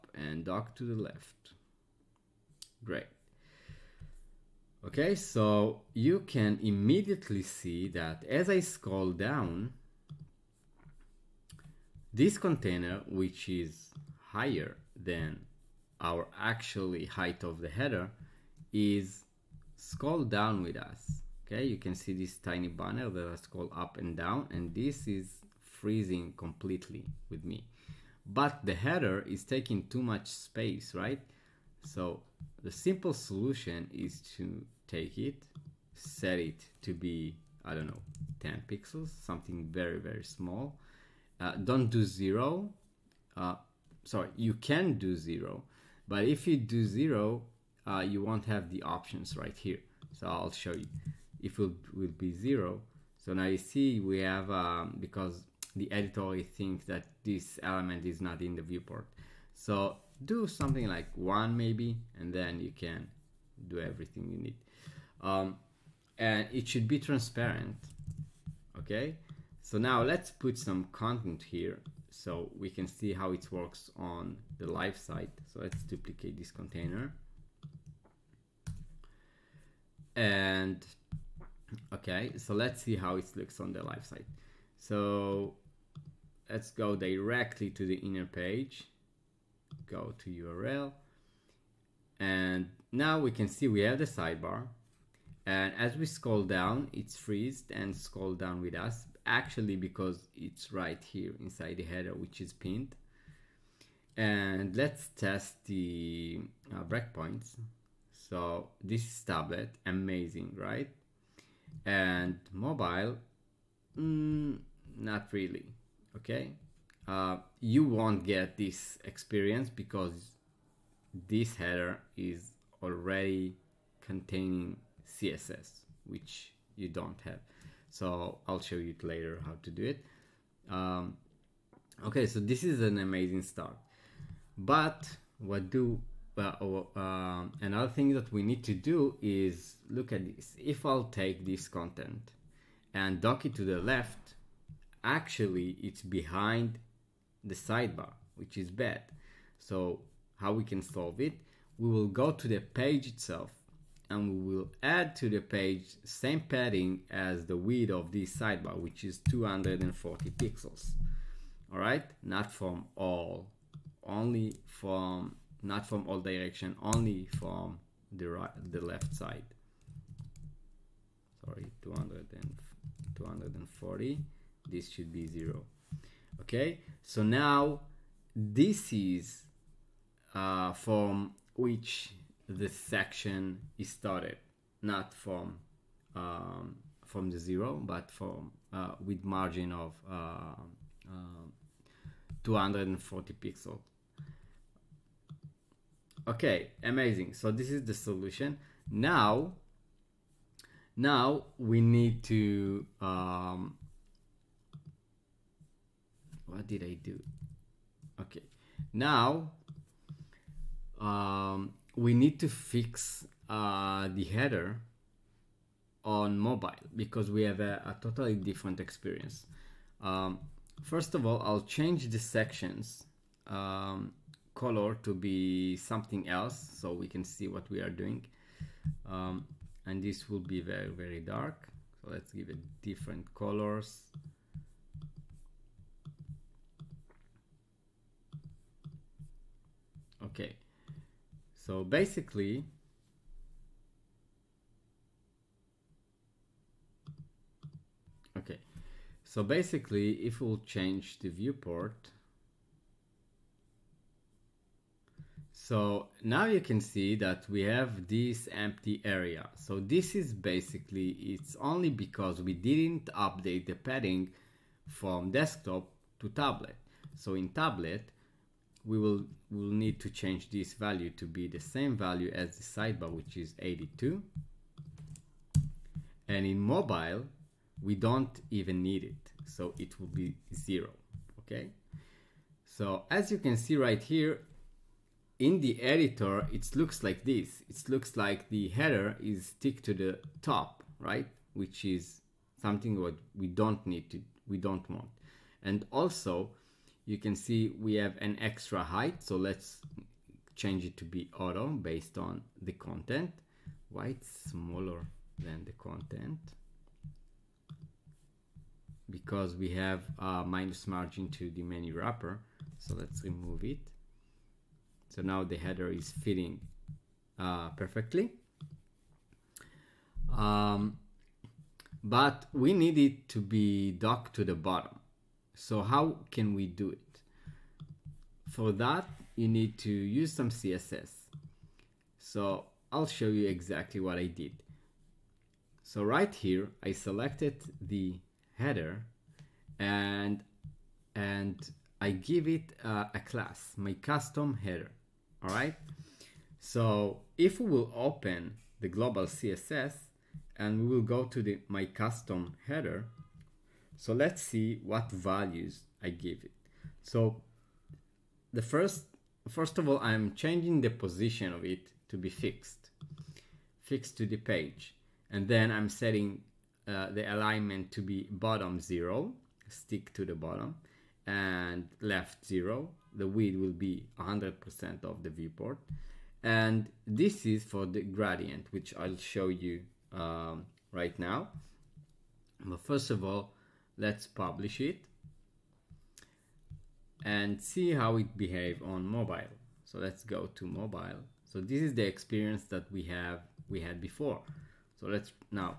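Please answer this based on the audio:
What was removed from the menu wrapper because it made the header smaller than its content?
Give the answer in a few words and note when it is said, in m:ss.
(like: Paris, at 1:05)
minus margin, at 5:10.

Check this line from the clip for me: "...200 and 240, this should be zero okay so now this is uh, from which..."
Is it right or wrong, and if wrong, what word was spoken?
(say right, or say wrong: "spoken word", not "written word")
right.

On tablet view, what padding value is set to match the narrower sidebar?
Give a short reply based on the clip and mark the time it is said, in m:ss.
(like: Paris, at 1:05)
82, at 4:33.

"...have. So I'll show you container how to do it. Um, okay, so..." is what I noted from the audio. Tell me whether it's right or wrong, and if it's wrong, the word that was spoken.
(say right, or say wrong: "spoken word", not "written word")
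wrong: "later", not "container".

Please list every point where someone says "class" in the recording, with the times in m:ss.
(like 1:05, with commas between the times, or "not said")
5:43.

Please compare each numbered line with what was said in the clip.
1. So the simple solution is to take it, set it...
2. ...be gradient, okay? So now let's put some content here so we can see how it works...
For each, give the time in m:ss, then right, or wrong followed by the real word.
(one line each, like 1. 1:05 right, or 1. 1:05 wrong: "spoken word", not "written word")
1. 0:31 right
2. 1:06 wrong: "transparent", not "gradient".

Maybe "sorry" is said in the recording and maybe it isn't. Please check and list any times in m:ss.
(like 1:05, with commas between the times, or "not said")
0:44, 2:51.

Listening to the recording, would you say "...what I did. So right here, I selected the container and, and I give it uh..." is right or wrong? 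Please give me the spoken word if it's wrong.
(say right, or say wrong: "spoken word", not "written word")
wrong: "header", not "container".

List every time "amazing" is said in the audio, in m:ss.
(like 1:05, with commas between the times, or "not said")
1:49, 2:12, 3:16.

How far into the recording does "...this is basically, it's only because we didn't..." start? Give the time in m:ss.
4:19.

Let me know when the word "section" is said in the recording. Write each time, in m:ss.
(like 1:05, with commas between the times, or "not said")
3:02, 3:42.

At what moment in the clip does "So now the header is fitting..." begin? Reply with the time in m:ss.
5:15.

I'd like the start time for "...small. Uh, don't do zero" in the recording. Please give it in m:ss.
0:40.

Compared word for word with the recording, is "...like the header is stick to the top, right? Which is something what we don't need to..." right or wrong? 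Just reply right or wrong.
right.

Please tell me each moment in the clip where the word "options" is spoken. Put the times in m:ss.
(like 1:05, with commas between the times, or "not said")
0:48.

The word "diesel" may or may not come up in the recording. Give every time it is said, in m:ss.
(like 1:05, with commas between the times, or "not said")
not said.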